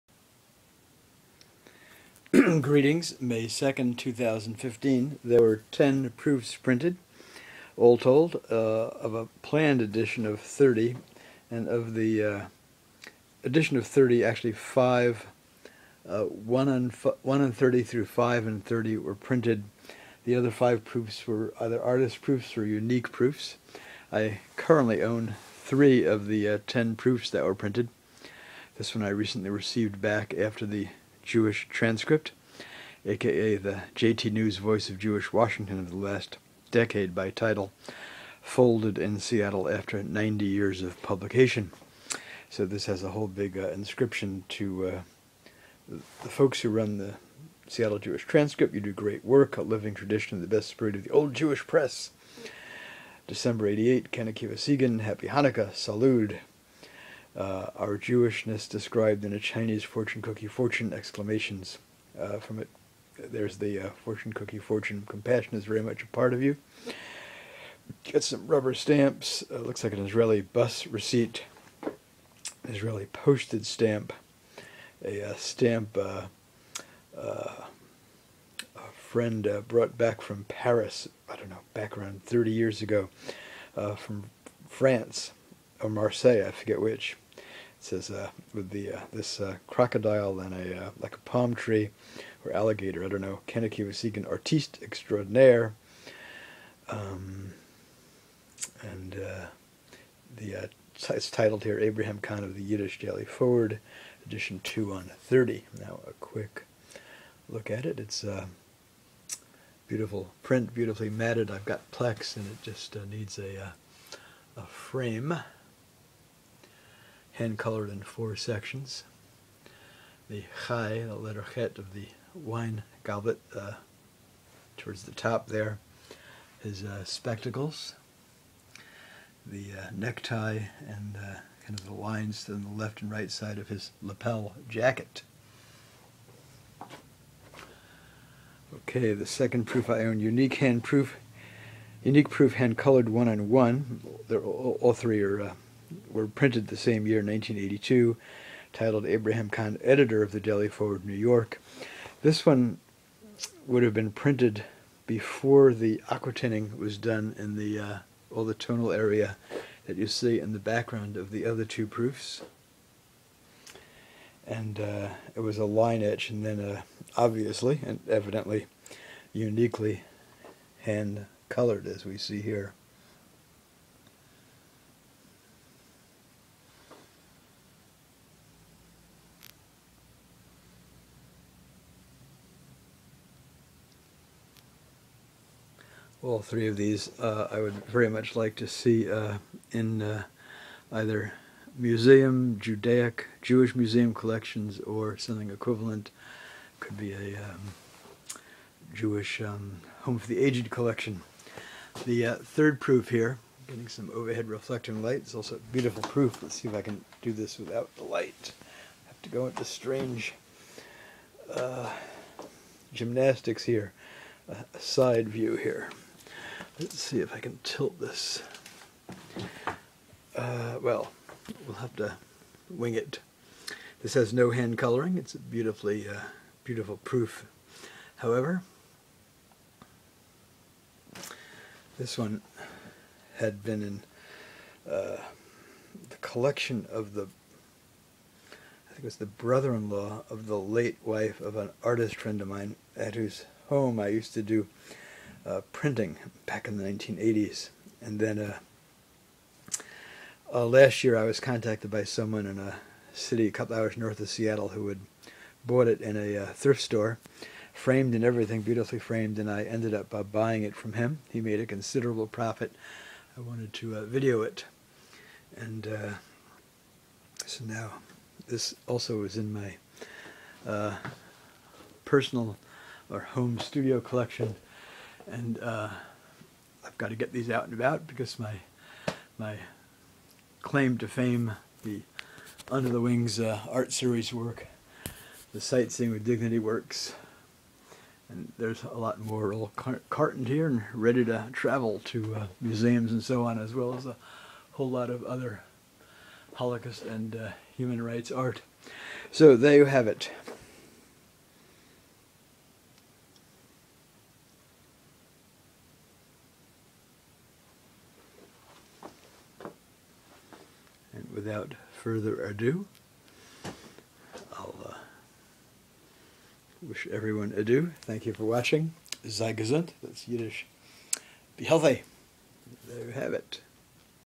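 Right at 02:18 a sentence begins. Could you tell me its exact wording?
Okay, the second proof I own, unique hand proof, unique proof hand colored one on one.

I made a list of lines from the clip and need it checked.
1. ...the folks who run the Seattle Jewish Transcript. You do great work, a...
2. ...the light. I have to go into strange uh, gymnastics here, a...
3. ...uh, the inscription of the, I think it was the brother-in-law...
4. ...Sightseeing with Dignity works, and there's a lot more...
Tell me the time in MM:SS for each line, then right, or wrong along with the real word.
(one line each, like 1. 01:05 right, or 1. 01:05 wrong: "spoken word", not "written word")
1. 00:45 right
2. 03:27 right
3. 03:54 wrong: "collection", not "inscription"
4. 04:45 right.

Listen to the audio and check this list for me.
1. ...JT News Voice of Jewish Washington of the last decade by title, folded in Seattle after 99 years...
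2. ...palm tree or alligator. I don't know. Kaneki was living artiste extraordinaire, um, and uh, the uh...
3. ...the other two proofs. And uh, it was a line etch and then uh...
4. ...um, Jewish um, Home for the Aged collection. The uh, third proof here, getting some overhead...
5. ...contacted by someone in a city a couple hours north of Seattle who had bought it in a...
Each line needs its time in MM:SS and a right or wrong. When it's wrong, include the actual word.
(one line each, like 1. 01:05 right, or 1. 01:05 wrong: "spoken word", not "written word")
1. 00:33 wrong: "90", not "99"
2. 01:31 wrong: "seeking", not "living"
3. 02:41 right
4. 03:17 right
5. 04:11 right.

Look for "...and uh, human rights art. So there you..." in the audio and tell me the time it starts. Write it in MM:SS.
04:57.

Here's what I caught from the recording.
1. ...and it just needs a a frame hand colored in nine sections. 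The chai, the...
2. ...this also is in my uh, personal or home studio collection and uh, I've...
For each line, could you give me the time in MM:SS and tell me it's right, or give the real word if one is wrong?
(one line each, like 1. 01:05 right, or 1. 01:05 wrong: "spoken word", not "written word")
1. 01:52 wrong: "four", not "nine"
2. 04:28 right.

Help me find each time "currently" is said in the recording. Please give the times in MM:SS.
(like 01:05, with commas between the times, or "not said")
00:24.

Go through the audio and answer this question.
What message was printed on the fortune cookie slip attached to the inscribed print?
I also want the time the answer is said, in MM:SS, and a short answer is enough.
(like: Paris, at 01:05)
Compassion is very much a part of you, at 01:05.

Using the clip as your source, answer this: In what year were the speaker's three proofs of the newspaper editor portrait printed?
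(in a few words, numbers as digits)
1982.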